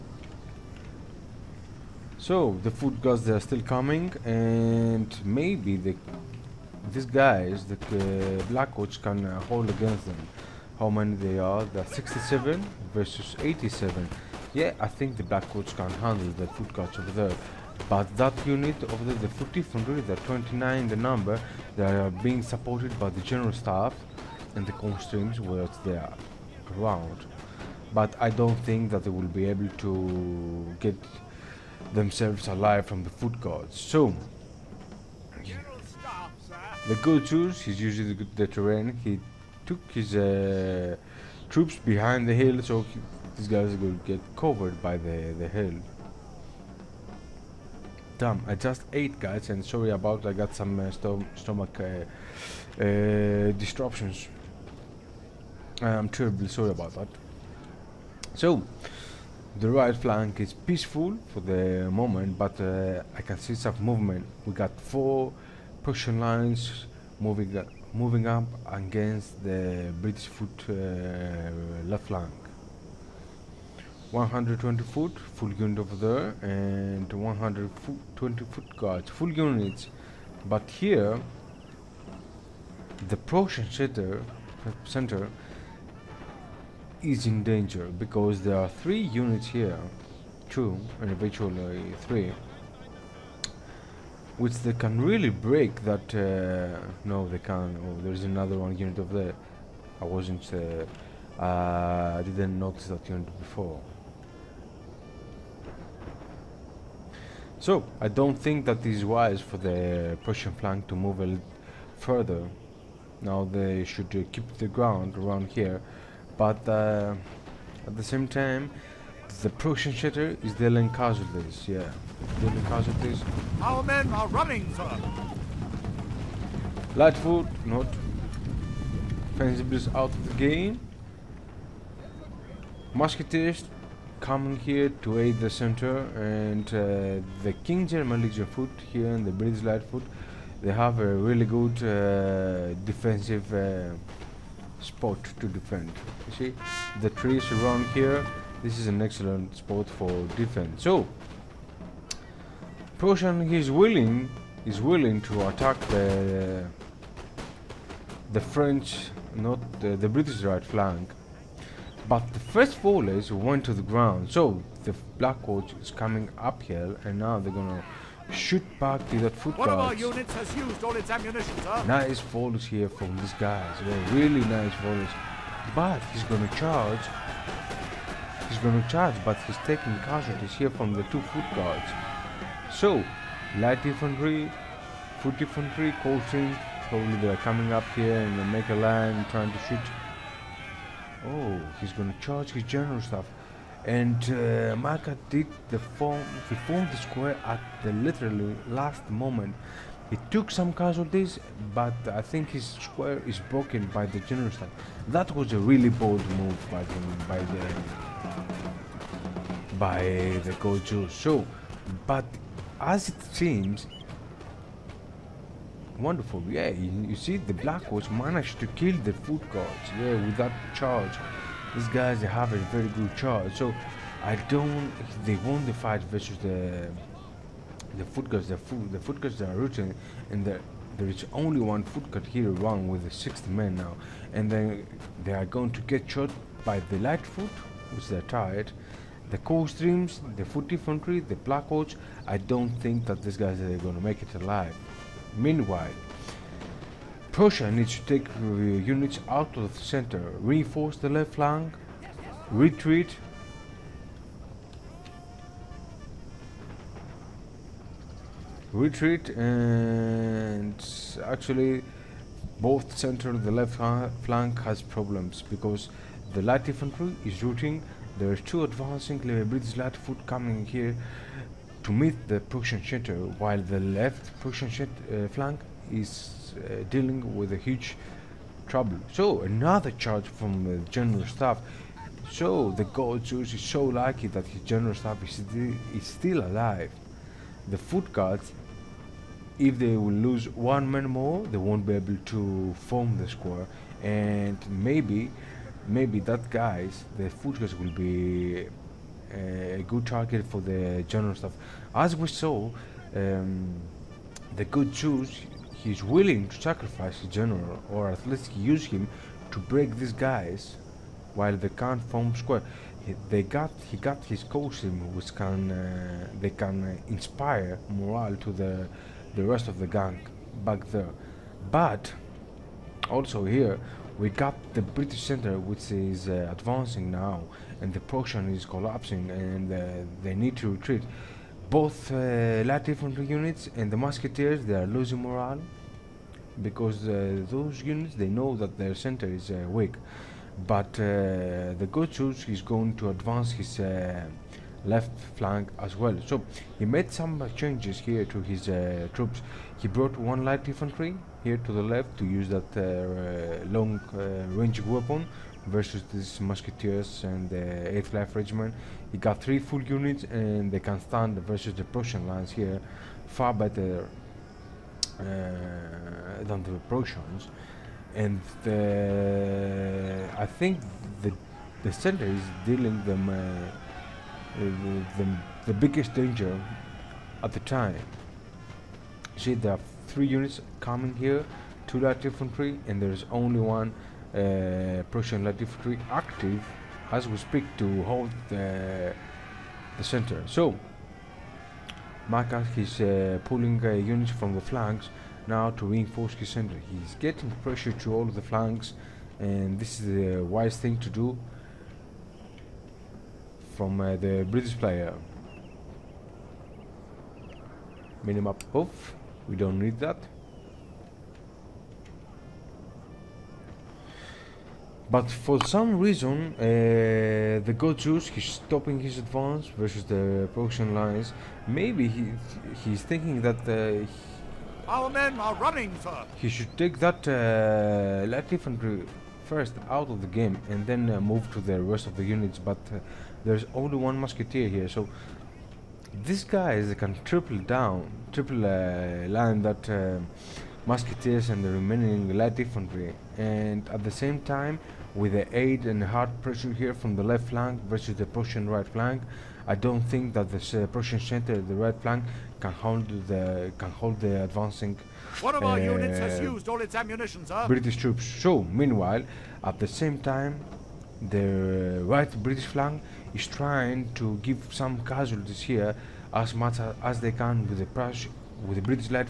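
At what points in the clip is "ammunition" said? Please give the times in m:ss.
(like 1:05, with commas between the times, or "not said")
2:51, 7:36.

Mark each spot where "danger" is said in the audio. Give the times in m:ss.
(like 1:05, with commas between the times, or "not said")
1:27, 6:16.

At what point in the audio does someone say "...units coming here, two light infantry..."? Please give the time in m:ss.
6:20.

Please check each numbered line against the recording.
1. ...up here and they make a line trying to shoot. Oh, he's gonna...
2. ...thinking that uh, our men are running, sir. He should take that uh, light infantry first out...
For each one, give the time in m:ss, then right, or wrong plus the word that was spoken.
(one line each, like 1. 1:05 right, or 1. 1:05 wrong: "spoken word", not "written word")
1. 3:07 right
2. 7:03 right.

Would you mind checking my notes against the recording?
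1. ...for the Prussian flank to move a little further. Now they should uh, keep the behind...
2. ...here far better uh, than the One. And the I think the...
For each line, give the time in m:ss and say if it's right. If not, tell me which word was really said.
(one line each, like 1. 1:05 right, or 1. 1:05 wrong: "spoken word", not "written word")
1. 1:49 wrong: "ground", not "behind"
2. 6:02 wrong: "Prussians", not "One".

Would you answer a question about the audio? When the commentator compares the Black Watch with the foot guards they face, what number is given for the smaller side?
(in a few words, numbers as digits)
67.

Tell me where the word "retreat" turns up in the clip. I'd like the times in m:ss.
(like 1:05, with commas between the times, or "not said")
4:12, 4:18, 5:30.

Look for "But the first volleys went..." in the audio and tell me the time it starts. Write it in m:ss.
2:42.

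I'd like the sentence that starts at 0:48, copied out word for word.
Damn, I just ate guys and sorry about I got some uh, stom stomach uh, uh disruptions.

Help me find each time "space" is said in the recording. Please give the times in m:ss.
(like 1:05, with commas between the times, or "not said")
not said.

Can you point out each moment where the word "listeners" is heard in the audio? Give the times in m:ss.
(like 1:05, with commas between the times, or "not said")
not said.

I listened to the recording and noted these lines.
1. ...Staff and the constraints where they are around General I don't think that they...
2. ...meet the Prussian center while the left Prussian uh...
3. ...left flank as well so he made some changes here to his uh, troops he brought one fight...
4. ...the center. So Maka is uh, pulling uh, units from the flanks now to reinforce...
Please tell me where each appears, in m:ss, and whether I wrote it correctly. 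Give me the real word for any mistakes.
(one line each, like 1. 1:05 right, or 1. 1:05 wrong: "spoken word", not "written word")
1. 0:23 wrong: "But", not "General"
2. 4:31 right
3. 5:44 wrong: "light", not "fight"
4. 6:29 right.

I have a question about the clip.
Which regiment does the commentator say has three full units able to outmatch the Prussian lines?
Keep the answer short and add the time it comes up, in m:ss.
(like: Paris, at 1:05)
8th life regiment, at 5:57.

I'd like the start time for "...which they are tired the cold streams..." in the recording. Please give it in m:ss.
3:57.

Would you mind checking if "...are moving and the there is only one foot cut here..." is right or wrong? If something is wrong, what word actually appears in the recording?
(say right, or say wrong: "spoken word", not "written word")
wrong: "rooting", not "moving".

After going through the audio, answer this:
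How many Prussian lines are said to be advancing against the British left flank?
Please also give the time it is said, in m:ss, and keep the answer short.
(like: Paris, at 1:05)
4, at 1:04.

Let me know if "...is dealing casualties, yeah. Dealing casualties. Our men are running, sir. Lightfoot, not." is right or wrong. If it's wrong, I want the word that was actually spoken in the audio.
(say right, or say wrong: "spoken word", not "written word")
right.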